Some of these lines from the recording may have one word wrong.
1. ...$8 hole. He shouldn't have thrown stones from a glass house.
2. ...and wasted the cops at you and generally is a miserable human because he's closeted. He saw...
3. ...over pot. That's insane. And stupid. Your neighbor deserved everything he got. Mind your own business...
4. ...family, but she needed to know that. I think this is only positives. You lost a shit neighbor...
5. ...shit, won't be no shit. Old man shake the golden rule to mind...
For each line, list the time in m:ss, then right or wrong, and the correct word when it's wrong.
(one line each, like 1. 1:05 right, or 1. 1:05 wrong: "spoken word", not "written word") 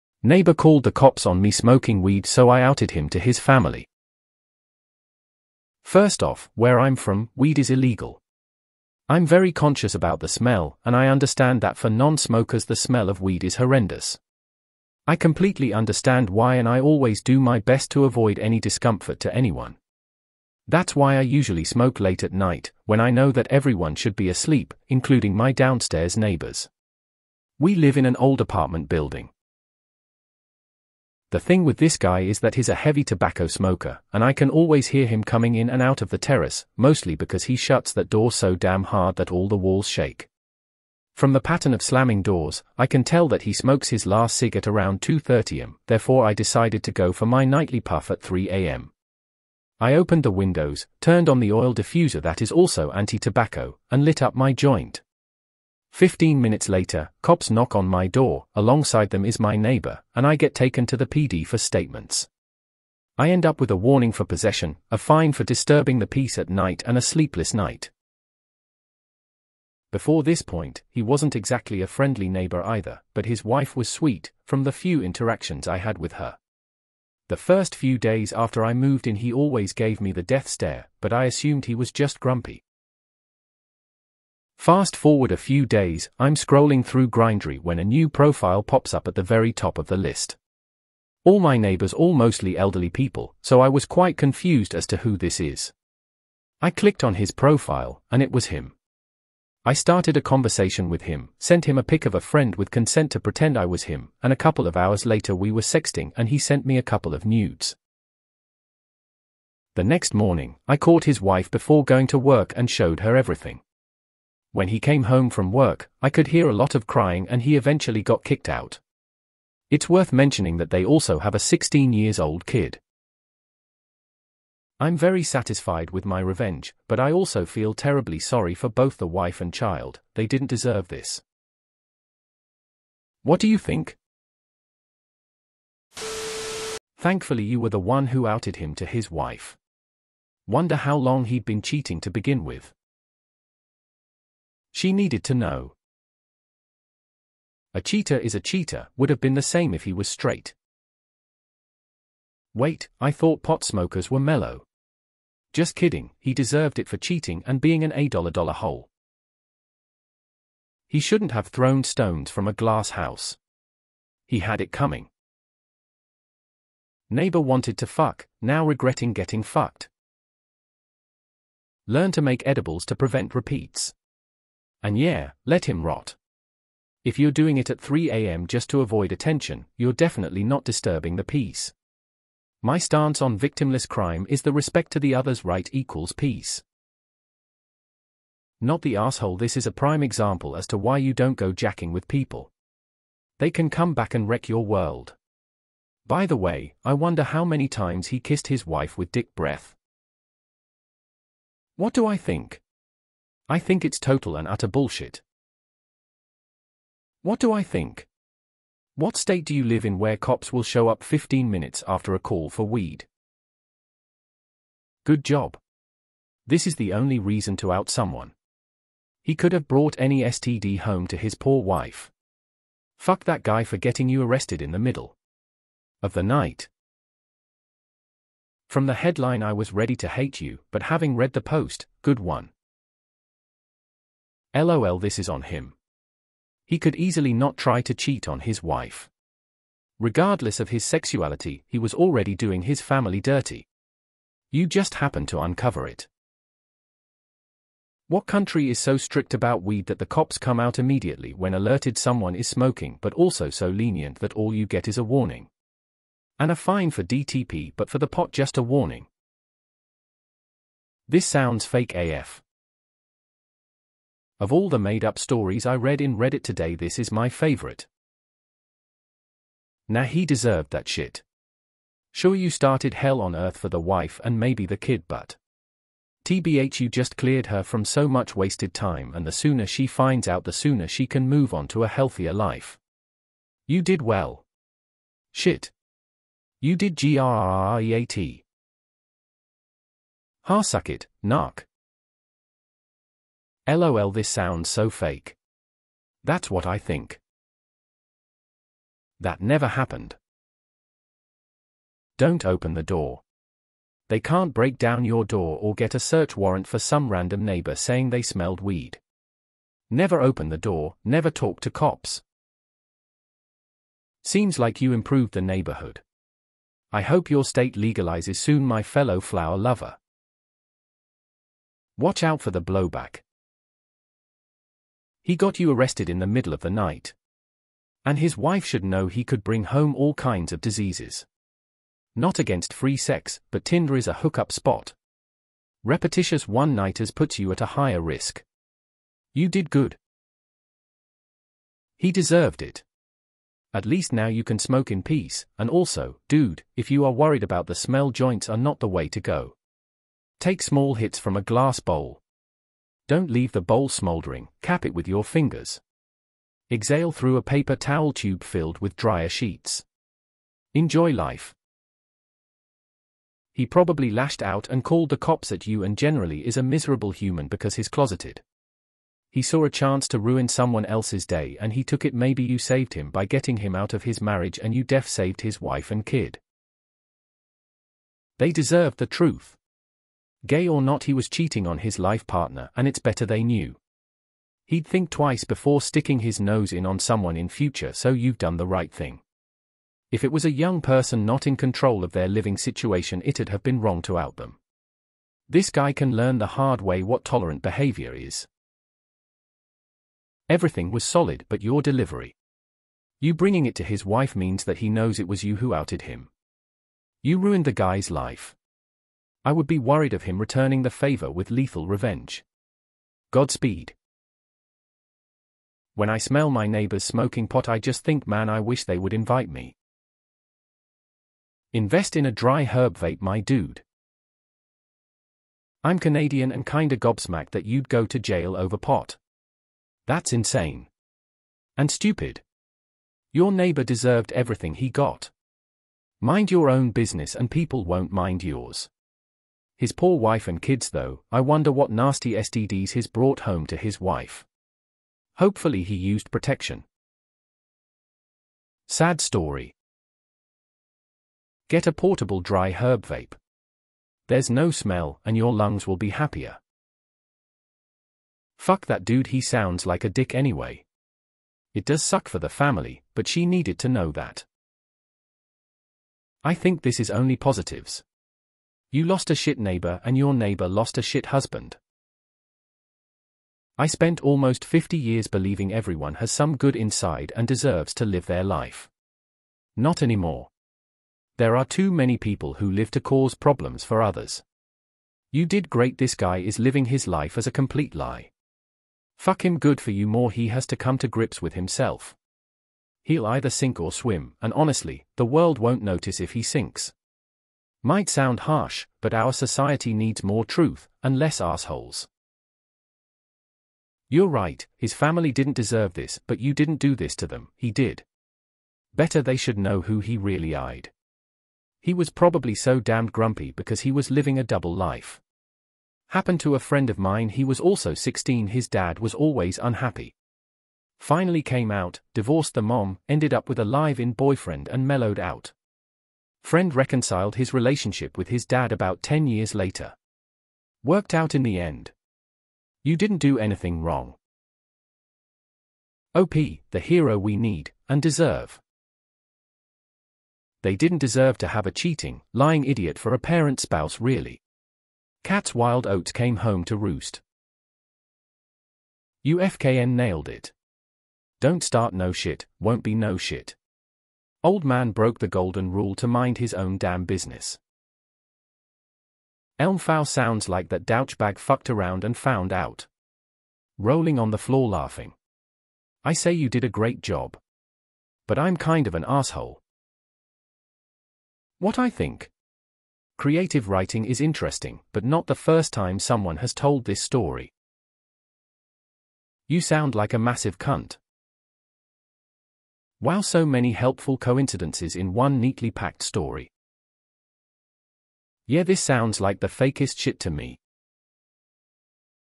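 1. 2:37 right
2. 6:04 wrong: "called", not "wasted"
3. 7:08 right
4. 7:42 right
5. 9:12 wrong: "broke", not "shake".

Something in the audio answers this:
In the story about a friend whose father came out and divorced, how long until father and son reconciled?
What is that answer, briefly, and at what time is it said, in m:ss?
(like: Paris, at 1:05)
10 years, at 8:49.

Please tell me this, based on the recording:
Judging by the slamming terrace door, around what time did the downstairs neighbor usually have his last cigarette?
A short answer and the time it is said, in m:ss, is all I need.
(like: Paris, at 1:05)
2:30 am, at 0:44.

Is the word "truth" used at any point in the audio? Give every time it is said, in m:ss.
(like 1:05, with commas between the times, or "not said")
6:19, 8:20.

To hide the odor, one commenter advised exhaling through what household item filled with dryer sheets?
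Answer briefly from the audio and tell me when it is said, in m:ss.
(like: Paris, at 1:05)
Paper towel tube, at 5:57.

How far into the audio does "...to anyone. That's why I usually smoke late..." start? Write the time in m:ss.
0:19.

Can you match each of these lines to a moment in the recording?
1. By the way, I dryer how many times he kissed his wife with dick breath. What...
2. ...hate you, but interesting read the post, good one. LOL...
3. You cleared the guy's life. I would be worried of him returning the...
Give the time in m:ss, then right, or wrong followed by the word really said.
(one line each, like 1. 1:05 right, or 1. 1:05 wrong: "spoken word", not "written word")
1. 3:16 wrong: "wonder", not "dryer"
2. 3:50 wrong: "having", not "interesting"
3. 6:47 wrong: "ruined", not "cleared".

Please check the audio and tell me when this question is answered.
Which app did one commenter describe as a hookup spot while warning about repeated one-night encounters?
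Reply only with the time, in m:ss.
5:33.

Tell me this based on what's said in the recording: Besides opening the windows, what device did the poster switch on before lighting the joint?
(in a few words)
Oil diffuser.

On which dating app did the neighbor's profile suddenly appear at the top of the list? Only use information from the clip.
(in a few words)
Grindr.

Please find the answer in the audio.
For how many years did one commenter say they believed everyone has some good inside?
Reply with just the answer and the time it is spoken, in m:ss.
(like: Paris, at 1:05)
50 years, at 7:54.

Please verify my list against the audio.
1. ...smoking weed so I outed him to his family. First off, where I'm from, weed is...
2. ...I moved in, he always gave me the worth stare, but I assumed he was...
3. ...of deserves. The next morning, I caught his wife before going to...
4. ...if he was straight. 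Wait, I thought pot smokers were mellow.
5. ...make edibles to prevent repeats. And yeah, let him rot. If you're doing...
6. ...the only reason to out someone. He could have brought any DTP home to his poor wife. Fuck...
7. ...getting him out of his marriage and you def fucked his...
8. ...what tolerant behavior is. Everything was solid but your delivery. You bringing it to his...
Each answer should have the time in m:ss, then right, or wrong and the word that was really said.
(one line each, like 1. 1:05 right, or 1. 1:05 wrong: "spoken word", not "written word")
1. 0:01 right
2. 1:18 wrong: "death", not "worth"
3. 1:47 wrong: "nudes", not "deserves"
4. 2:29 right
5. 2:52 right
6. 3:36 wrong: "STD", not "DTP"
7. 6:13 wrong: "saved", not "fucked"
8. 6:37 right.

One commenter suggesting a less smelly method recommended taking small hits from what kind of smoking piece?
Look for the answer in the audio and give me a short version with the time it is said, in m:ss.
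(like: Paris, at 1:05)
Glass bowl, at 5:51.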